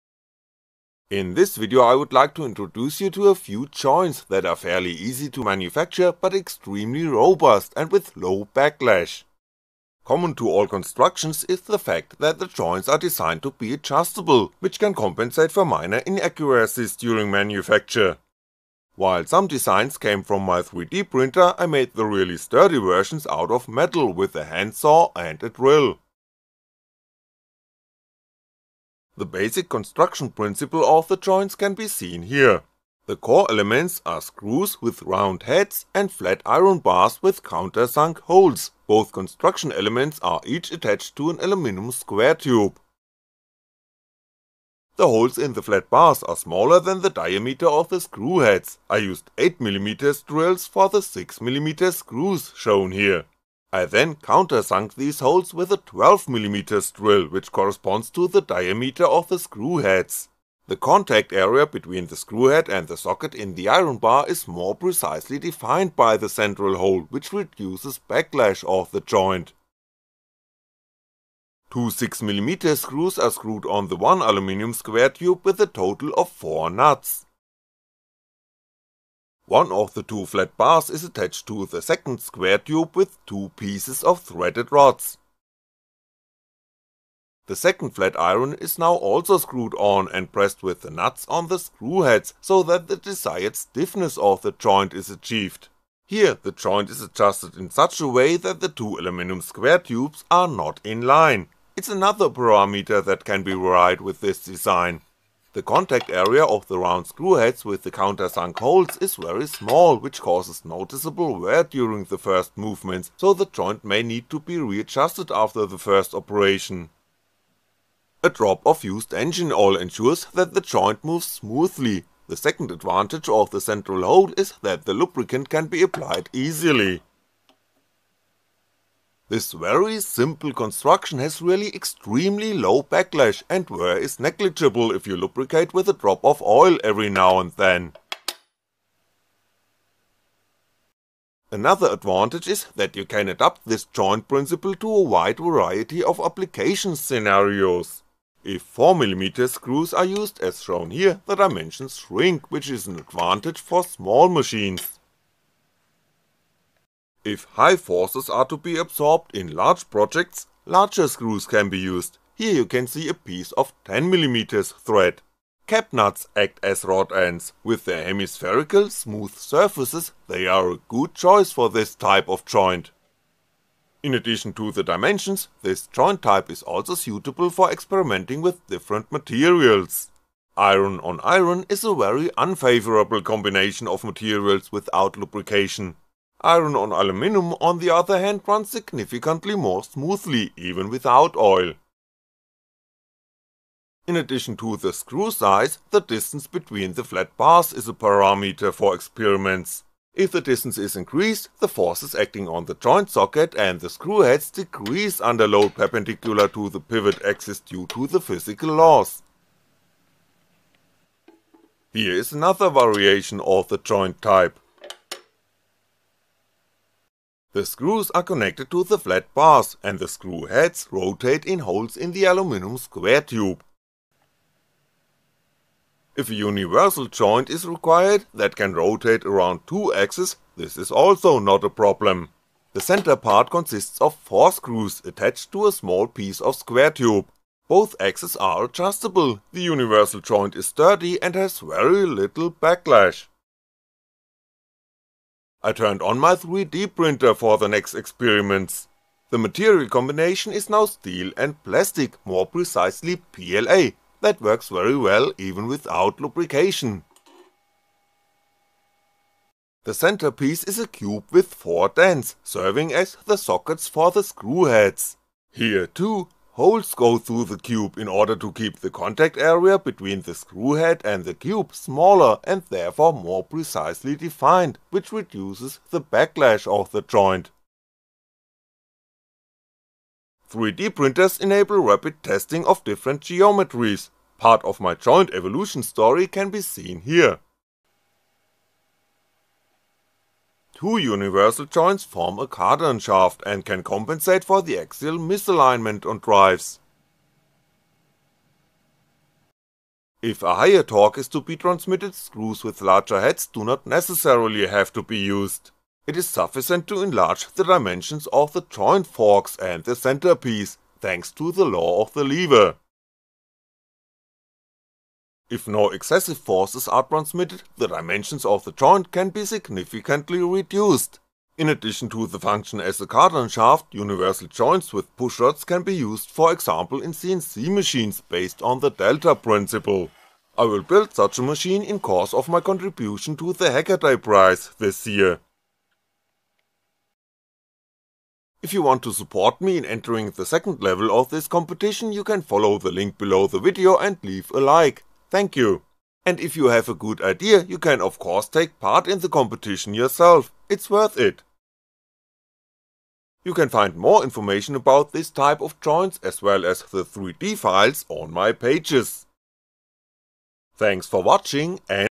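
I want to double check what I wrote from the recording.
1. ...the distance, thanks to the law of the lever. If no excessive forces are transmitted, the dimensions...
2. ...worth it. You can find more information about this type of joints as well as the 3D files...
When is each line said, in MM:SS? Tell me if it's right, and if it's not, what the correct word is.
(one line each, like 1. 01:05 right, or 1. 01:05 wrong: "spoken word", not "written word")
1. 05:09 wrong: "centerpiece", not "distance"
2. 05:50 right.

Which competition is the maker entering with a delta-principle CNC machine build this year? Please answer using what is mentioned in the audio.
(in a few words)
Hackaday Prize.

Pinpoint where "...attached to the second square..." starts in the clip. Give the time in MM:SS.
01:21.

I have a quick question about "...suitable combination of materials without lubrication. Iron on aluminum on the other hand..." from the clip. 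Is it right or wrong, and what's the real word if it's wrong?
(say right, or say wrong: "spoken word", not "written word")
wrong: "unfavourable", not "suitable".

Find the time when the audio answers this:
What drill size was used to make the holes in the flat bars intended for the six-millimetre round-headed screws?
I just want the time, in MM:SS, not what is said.
00:49.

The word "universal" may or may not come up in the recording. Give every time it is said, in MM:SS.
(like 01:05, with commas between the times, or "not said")
03:46, 03:59, 04:50, 05:23.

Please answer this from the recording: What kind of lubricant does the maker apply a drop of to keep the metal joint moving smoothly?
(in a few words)
used engine oil.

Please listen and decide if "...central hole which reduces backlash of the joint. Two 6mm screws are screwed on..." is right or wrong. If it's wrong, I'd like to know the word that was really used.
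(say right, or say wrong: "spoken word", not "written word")
right.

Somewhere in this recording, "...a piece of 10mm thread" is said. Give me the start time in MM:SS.
02:43.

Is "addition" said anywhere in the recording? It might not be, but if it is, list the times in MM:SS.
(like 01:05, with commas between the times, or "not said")
02:54, 03:14, 05:21.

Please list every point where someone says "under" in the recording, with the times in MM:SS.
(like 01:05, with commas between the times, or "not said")
03:25.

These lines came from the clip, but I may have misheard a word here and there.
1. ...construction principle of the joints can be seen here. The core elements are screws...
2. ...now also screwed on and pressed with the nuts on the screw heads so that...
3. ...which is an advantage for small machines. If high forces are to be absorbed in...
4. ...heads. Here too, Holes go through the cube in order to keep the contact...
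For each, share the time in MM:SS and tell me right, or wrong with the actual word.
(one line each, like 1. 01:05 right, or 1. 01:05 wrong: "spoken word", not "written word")
1. 00:29 right
2. 01:28 right
3. 02:32 right
4. 04:24 right.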